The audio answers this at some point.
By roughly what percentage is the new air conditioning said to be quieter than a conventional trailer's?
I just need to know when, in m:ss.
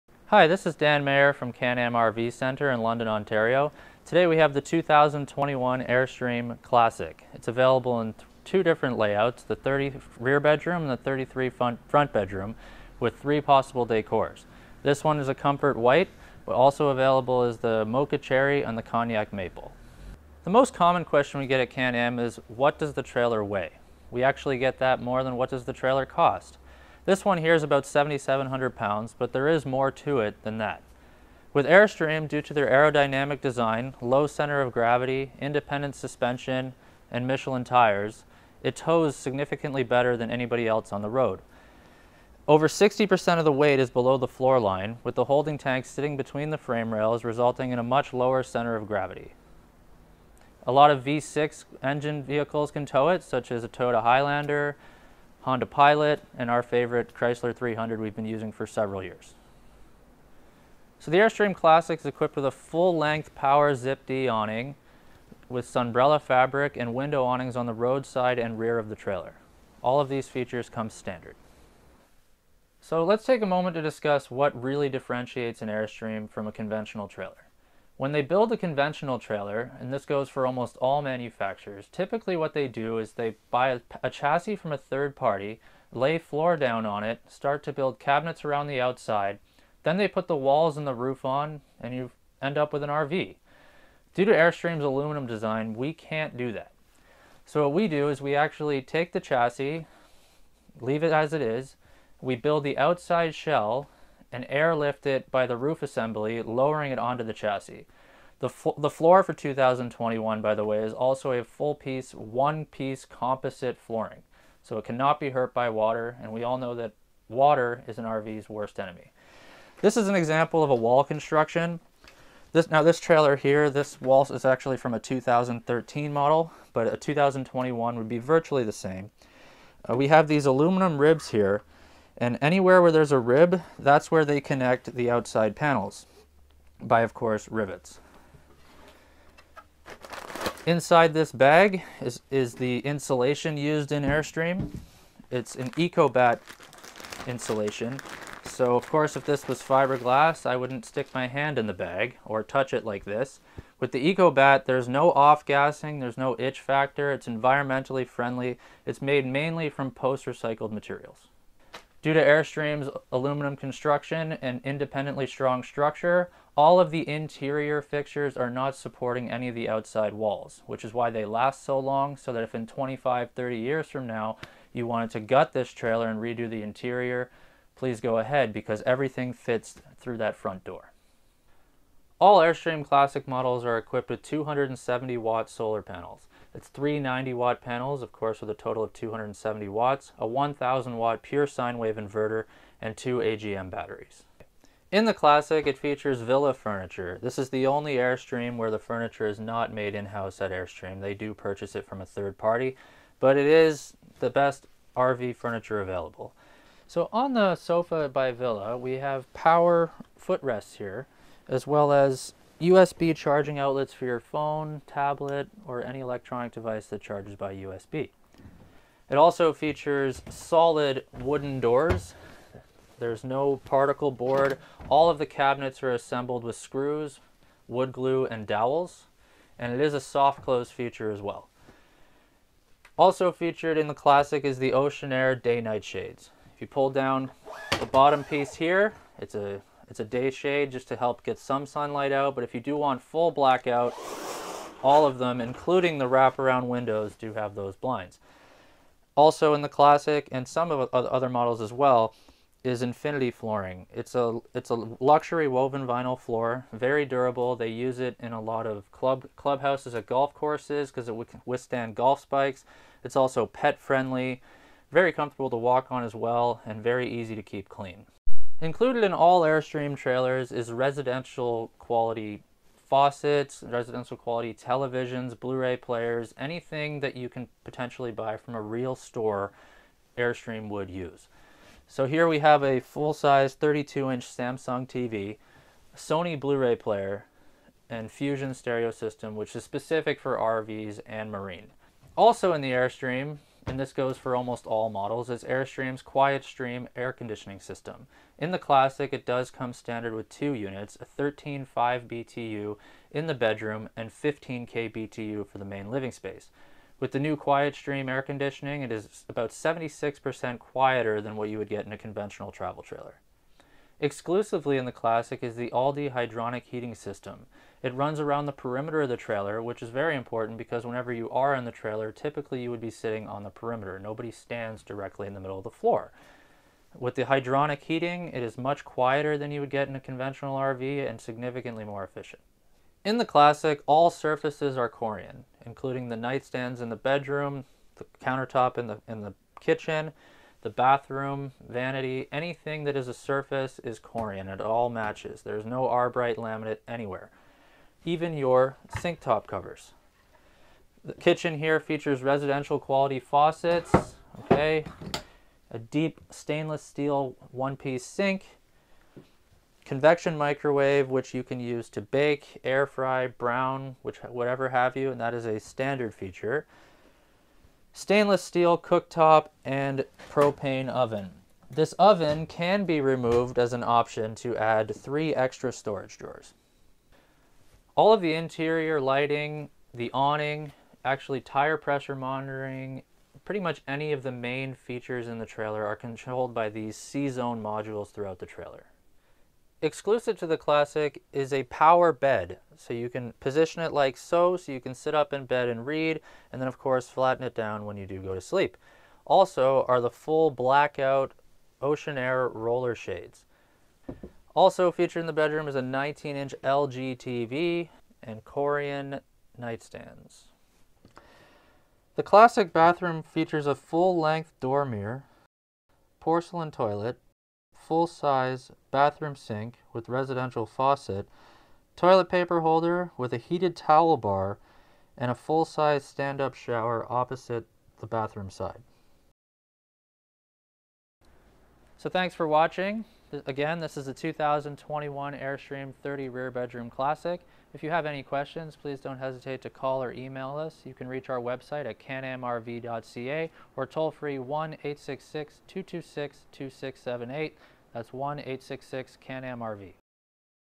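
5:09.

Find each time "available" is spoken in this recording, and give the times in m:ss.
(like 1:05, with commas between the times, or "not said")
0:07, 0:16, 3:25.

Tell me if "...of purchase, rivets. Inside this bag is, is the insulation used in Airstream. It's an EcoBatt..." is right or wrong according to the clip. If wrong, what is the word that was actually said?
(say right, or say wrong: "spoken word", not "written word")
wrong: "course", not "purchase".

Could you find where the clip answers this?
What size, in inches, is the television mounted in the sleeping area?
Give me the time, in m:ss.
6:45.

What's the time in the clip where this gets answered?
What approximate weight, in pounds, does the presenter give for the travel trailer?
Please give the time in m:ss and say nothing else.
0:27.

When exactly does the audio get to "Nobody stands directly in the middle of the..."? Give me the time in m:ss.
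5:23.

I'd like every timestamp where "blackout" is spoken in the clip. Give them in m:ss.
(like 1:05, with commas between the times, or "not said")
4:03, 6:40.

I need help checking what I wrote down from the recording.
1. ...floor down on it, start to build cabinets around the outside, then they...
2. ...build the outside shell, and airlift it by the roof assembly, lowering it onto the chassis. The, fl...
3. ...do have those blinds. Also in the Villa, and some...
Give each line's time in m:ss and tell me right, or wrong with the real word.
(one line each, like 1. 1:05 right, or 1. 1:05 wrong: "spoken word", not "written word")
1. 1:26 right
2. 1:42 right
3. 4:07 wrong: "Classic", not "Villa".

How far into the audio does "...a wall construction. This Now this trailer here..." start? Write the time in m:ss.
2:00.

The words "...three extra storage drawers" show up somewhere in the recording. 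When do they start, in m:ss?
6:14.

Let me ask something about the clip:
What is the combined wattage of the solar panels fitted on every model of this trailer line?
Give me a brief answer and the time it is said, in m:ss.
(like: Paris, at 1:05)
270 watts, at 3:08.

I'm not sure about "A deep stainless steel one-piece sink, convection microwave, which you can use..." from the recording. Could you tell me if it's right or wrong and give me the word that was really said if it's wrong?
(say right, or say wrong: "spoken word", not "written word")
right.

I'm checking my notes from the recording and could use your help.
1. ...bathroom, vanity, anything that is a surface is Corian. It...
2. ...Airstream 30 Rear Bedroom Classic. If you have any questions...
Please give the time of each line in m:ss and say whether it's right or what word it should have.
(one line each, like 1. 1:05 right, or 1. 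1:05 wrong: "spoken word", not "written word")
1. 5:40 right
2. 7:15 right.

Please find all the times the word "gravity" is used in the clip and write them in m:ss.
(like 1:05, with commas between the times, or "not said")
0:34, 0:48.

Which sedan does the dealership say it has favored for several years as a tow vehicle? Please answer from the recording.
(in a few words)
Chrysler 300.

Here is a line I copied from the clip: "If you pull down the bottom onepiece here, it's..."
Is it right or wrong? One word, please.
wrong.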